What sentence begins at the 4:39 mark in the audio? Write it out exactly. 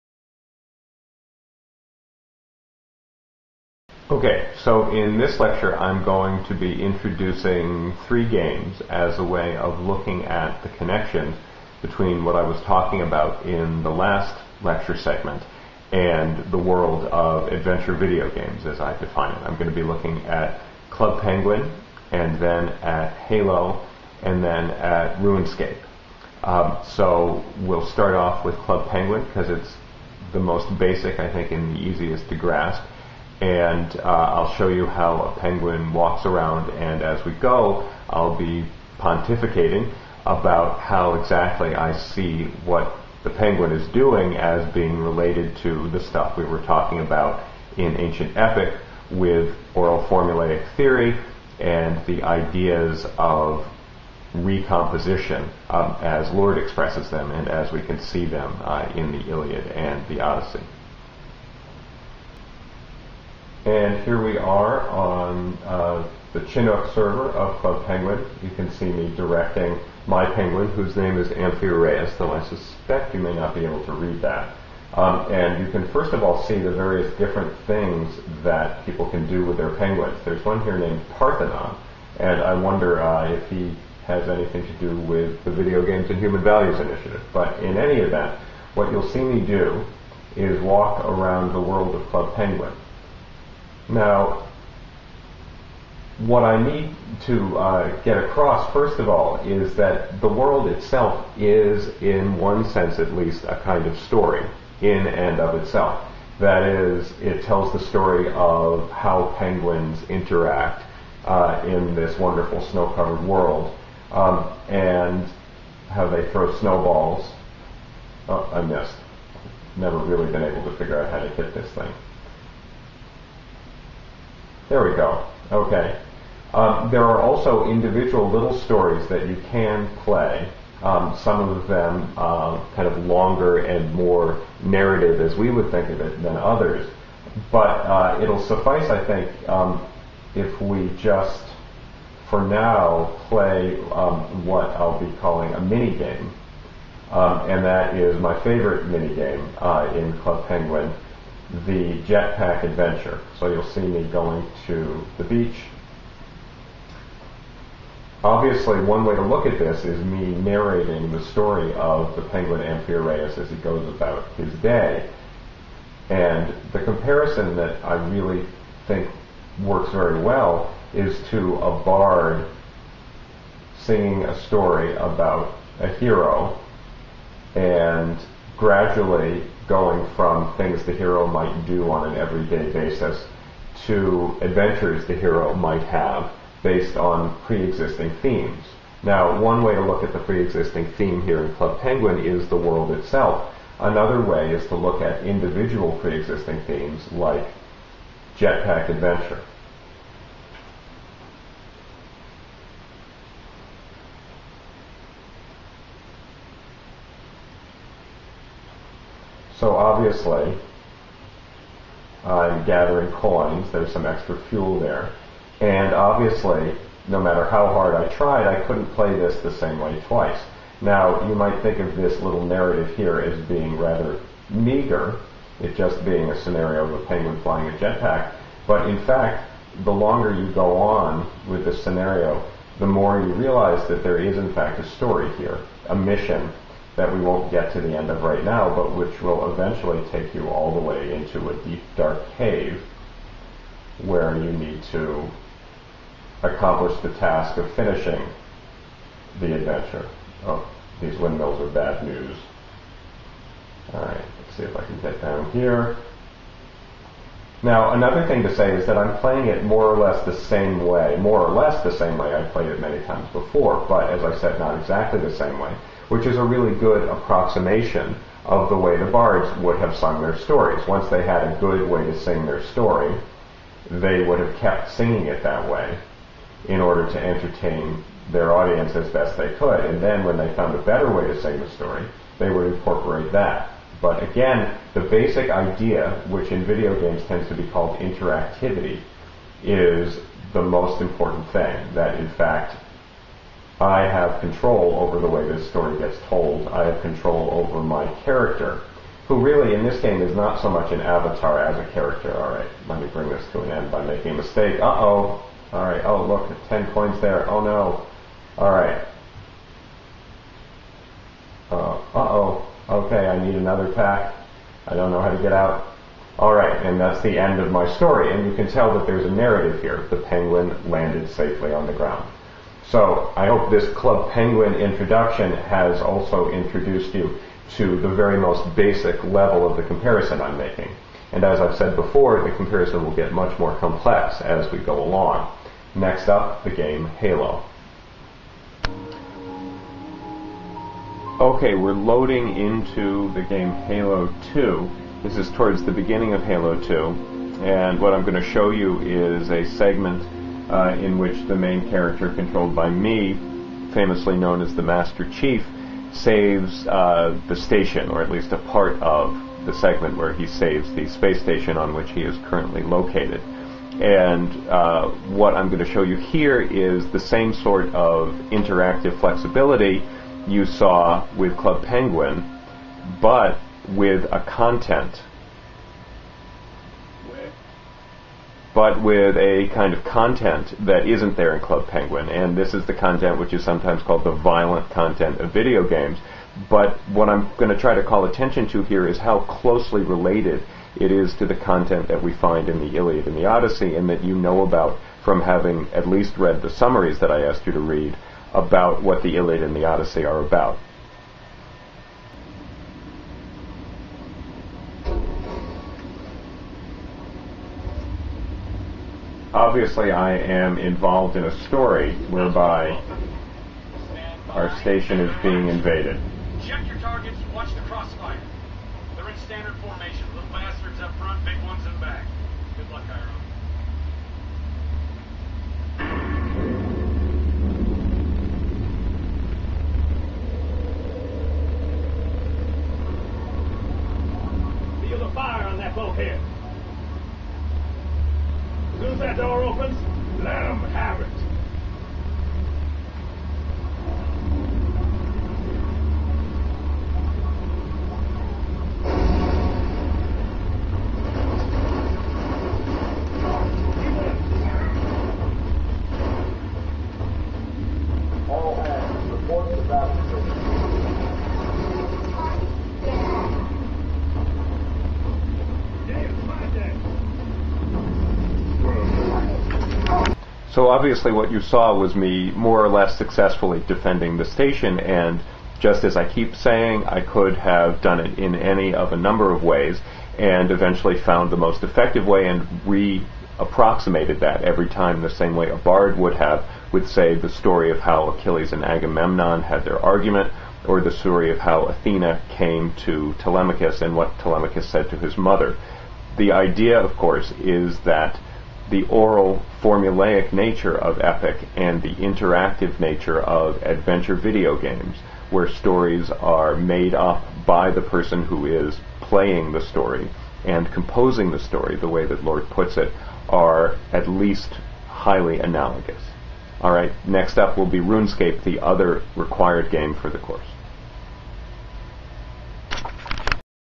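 And then when they found a better way to sing the story, they would incorporate that.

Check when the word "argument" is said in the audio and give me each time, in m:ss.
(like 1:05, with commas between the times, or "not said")
8:10.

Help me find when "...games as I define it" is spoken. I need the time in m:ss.
0:18.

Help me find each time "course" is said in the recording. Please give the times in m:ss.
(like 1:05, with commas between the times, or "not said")
8:17, 8:40.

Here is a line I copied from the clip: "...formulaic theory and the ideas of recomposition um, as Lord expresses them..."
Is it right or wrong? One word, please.
right.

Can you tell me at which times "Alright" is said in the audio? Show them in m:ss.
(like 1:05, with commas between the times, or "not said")
4:13, 8:36.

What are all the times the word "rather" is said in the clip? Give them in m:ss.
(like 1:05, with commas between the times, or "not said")
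3:43.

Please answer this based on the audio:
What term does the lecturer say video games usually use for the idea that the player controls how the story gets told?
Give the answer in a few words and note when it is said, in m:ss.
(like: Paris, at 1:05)
Interactivity, at 4:47.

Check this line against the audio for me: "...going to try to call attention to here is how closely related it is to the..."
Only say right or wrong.
right.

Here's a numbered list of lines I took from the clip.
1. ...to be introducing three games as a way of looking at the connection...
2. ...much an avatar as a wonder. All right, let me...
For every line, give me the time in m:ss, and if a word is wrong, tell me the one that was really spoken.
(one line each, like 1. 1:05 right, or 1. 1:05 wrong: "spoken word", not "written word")
1. 0:06 right
2. 5:00 wrong: "character", not "wonder".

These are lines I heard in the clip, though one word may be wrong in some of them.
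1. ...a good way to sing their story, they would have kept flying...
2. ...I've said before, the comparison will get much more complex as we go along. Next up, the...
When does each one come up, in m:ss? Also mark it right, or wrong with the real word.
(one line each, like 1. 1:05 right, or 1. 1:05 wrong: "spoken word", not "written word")
1. 4:31 wrong: "singing", not "flying"
2. 5:31 right.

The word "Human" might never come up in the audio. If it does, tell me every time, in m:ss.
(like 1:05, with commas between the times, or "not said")
1:26.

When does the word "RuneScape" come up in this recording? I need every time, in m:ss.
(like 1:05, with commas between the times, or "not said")
0:25, 8:37.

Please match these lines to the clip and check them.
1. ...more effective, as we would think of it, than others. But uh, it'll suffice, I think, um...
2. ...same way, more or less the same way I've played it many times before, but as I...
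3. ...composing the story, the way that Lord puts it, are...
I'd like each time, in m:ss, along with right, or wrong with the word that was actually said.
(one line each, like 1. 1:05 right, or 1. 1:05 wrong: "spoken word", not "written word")
1. 2:13 wrong: "narrative", not "effective"
2. 4:20 right
3. 8:30 right.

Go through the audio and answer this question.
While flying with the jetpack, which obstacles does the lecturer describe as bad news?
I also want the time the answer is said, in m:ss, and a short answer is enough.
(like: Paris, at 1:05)
Windmills, at 4:11.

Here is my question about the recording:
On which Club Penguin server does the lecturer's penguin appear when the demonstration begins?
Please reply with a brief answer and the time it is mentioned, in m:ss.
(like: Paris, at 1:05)
Chinook, at 1:06.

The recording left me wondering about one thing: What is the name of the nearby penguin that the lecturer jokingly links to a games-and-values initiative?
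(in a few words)
Parthenon.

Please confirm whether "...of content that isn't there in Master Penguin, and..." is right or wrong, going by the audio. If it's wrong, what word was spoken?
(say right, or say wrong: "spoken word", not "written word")
wrong: "Club", not "Master".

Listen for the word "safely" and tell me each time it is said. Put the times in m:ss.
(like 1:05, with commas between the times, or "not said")
5:21.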